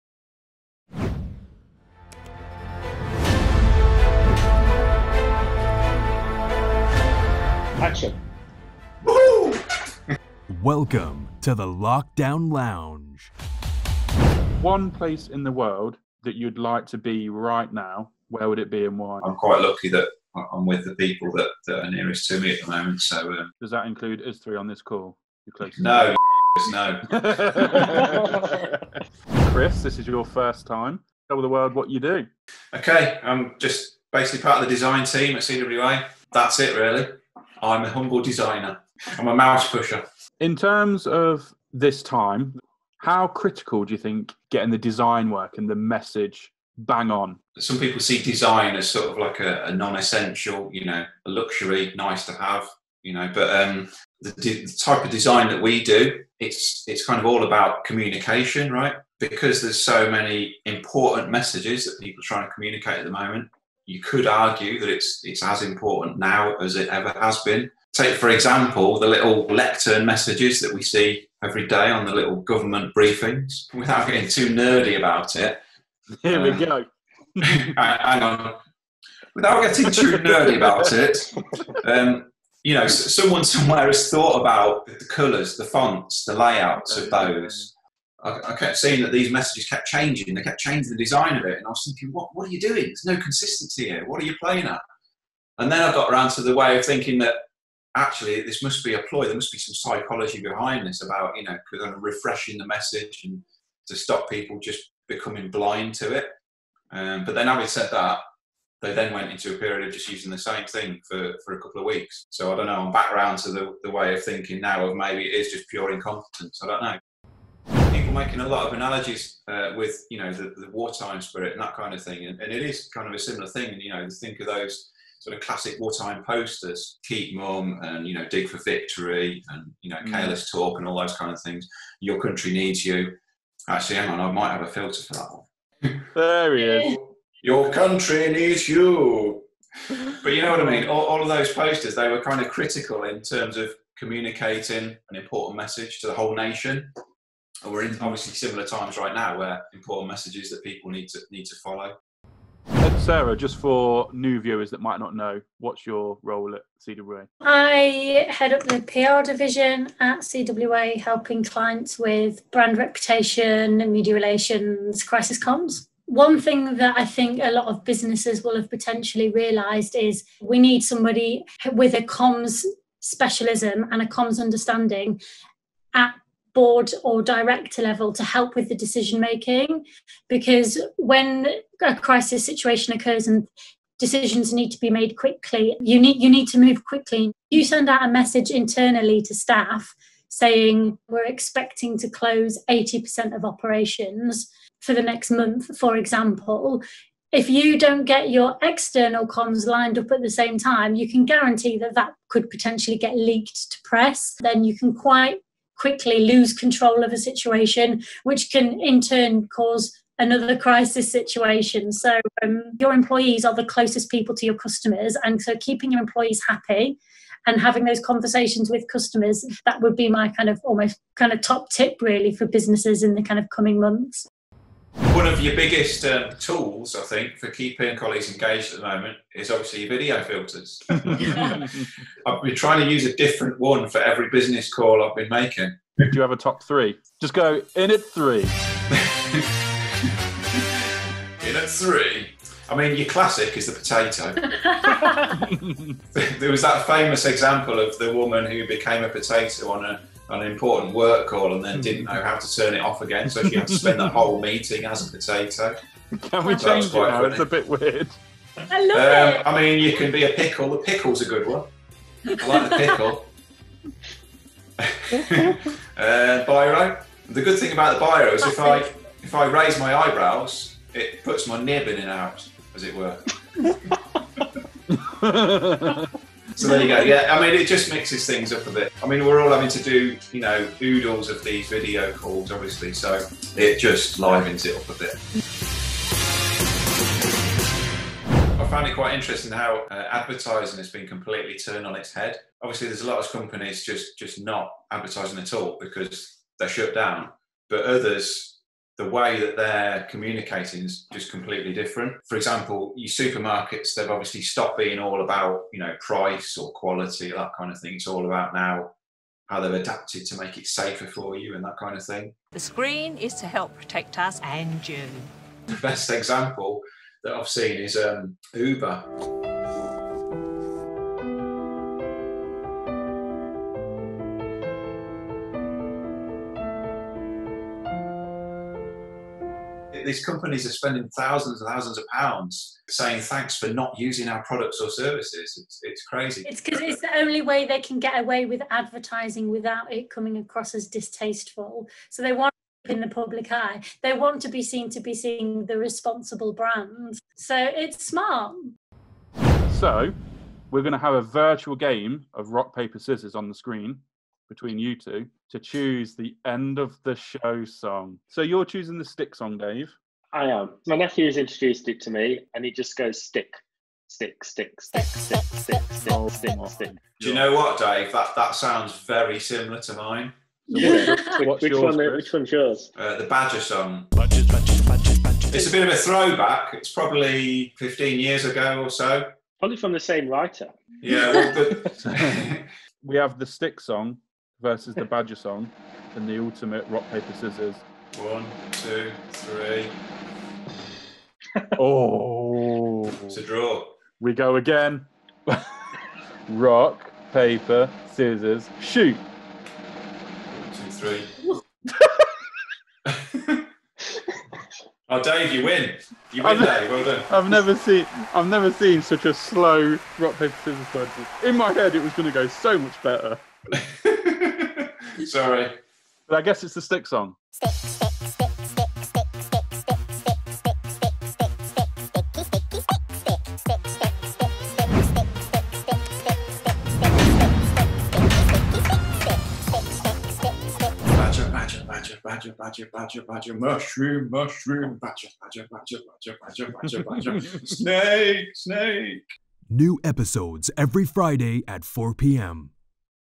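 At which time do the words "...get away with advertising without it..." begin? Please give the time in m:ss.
5:37.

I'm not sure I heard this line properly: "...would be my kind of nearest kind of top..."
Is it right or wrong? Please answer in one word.
wrong.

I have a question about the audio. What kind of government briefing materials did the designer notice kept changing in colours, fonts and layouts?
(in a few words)
lectern messages.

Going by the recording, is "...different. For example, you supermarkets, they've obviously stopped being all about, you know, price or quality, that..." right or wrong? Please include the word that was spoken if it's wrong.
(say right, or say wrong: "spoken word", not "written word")
right.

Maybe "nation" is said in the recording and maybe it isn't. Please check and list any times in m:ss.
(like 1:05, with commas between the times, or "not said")
2:26.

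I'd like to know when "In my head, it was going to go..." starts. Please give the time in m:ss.
6:51.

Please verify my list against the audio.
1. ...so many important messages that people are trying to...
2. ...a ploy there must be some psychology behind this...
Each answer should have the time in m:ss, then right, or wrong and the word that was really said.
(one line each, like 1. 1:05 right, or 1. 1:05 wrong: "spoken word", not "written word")
1. 0:59 right
2. 1:38 right.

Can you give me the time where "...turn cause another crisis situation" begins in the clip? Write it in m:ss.
3:29.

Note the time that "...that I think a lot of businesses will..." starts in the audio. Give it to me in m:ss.
2:46.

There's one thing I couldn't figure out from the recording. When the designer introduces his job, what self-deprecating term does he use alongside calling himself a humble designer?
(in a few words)
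mouse pusher.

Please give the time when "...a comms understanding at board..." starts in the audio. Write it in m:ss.
2:54.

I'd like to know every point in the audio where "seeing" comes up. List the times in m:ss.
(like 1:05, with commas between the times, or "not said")
1:28, 5:45.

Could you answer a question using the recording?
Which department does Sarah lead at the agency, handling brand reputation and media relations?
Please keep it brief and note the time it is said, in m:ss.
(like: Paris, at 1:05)
PR division, at 2:38.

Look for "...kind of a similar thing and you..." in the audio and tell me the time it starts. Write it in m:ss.
2:02.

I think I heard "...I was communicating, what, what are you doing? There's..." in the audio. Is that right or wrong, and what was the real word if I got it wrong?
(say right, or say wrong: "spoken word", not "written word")
wrong: "thinking", not "communicating".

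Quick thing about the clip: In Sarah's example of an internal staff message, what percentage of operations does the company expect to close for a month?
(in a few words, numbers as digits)
80%.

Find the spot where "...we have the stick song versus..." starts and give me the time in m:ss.
6:23.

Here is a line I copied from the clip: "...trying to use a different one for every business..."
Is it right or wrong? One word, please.
right.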